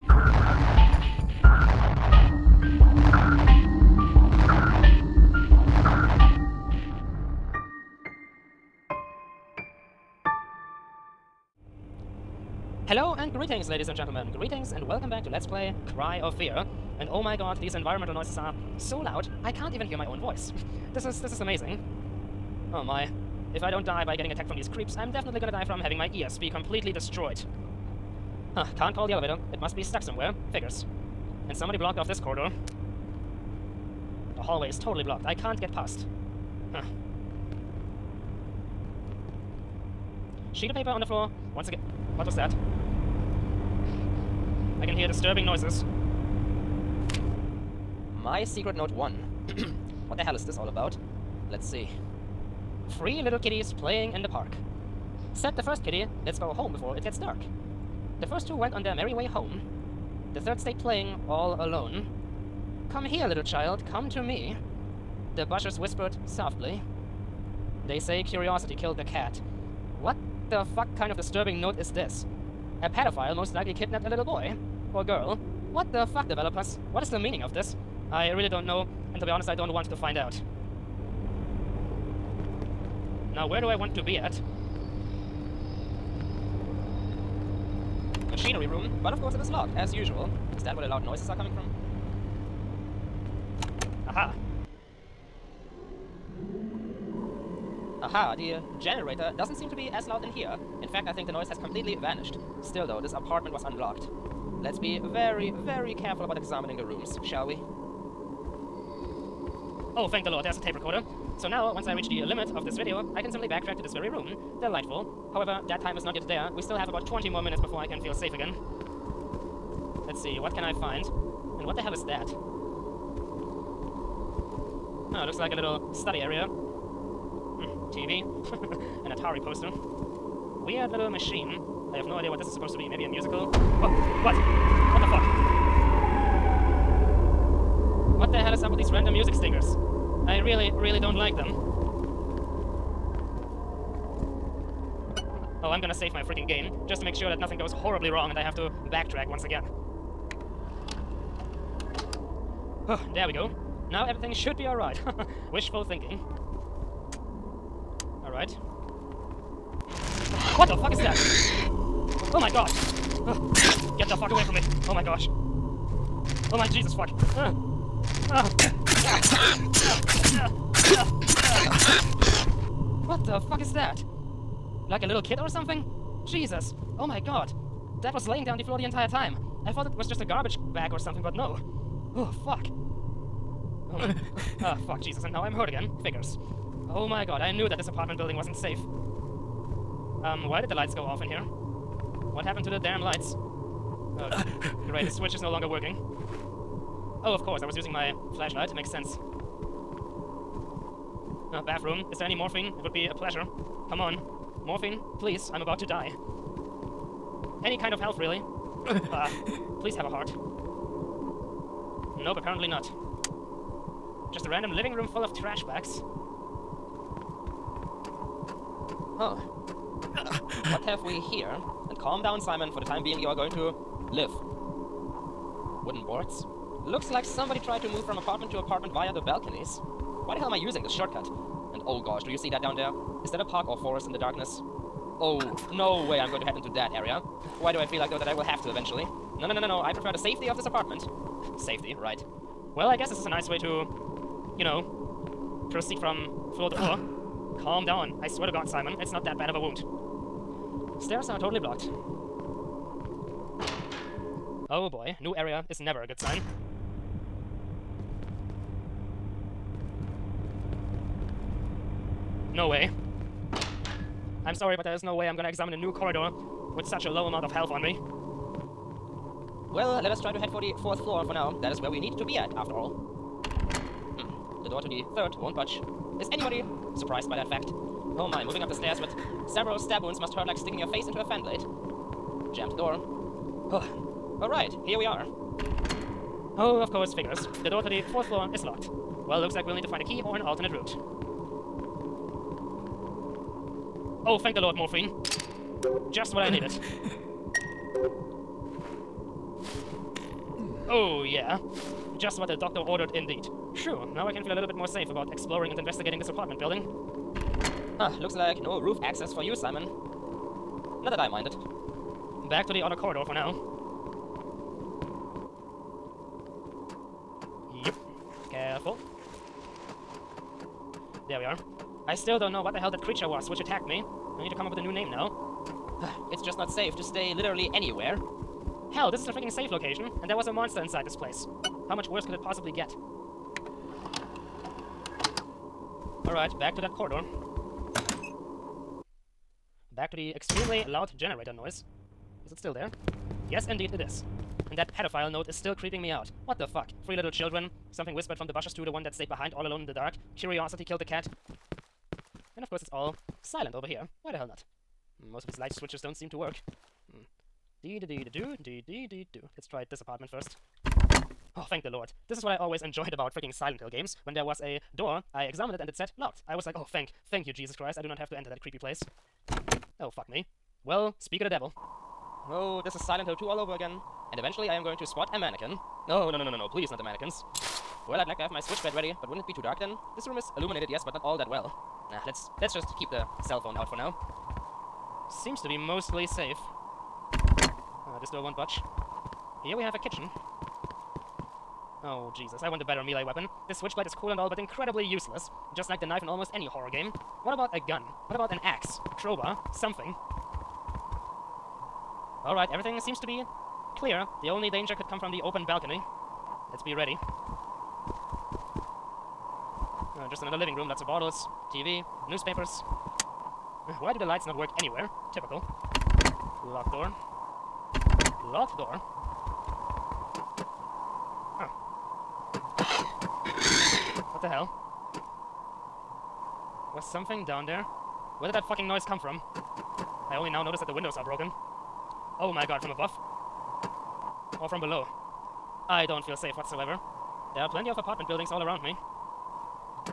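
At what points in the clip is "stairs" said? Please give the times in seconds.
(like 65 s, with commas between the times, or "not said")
251 s, 278 s.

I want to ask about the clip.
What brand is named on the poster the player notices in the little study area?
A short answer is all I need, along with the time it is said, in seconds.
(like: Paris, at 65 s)
Atari, at 129 s.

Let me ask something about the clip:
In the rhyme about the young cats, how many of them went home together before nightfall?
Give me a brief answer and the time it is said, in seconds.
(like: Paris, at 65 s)
2, at 58 s.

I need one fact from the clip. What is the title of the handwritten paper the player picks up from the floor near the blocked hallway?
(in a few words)
My secret note 1.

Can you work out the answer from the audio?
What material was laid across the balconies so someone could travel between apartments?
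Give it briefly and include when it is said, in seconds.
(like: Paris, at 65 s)
Wooden boards, at 225 s.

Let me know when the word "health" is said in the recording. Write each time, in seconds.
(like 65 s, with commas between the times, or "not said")
207 s, 267 s.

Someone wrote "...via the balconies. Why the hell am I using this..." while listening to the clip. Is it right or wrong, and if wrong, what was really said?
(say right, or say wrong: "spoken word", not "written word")
right.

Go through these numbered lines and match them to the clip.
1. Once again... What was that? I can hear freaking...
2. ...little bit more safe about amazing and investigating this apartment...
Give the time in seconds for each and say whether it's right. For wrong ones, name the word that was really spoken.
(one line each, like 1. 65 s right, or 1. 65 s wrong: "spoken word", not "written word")
1. 41 s wrong: "disturbing", not "freaking"
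2. 304 s wrong: "exploring", not "amazing".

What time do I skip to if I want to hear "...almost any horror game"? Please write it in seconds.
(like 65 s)
396 s.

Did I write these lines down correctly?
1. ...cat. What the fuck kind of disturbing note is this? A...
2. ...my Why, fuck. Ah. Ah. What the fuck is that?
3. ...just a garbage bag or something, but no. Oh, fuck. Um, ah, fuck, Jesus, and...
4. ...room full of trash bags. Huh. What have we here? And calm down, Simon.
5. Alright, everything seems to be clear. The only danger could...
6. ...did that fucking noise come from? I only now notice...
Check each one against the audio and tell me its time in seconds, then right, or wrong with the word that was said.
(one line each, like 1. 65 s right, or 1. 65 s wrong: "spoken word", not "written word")
1. 69 s right
2. 166 s wrong: "Jesus", not "Why"
3. 180 s right
4. 214 s right
5. 402 s right
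6. 428 s right.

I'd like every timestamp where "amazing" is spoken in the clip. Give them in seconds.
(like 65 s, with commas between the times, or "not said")
21 s.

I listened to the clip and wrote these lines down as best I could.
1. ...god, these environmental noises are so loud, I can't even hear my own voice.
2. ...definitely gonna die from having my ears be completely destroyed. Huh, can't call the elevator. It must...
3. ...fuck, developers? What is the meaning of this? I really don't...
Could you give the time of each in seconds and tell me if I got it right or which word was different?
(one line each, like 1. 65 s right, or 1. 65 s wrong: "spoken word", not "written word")
1. 17 s right
2. 25 s right
3. 76 s right.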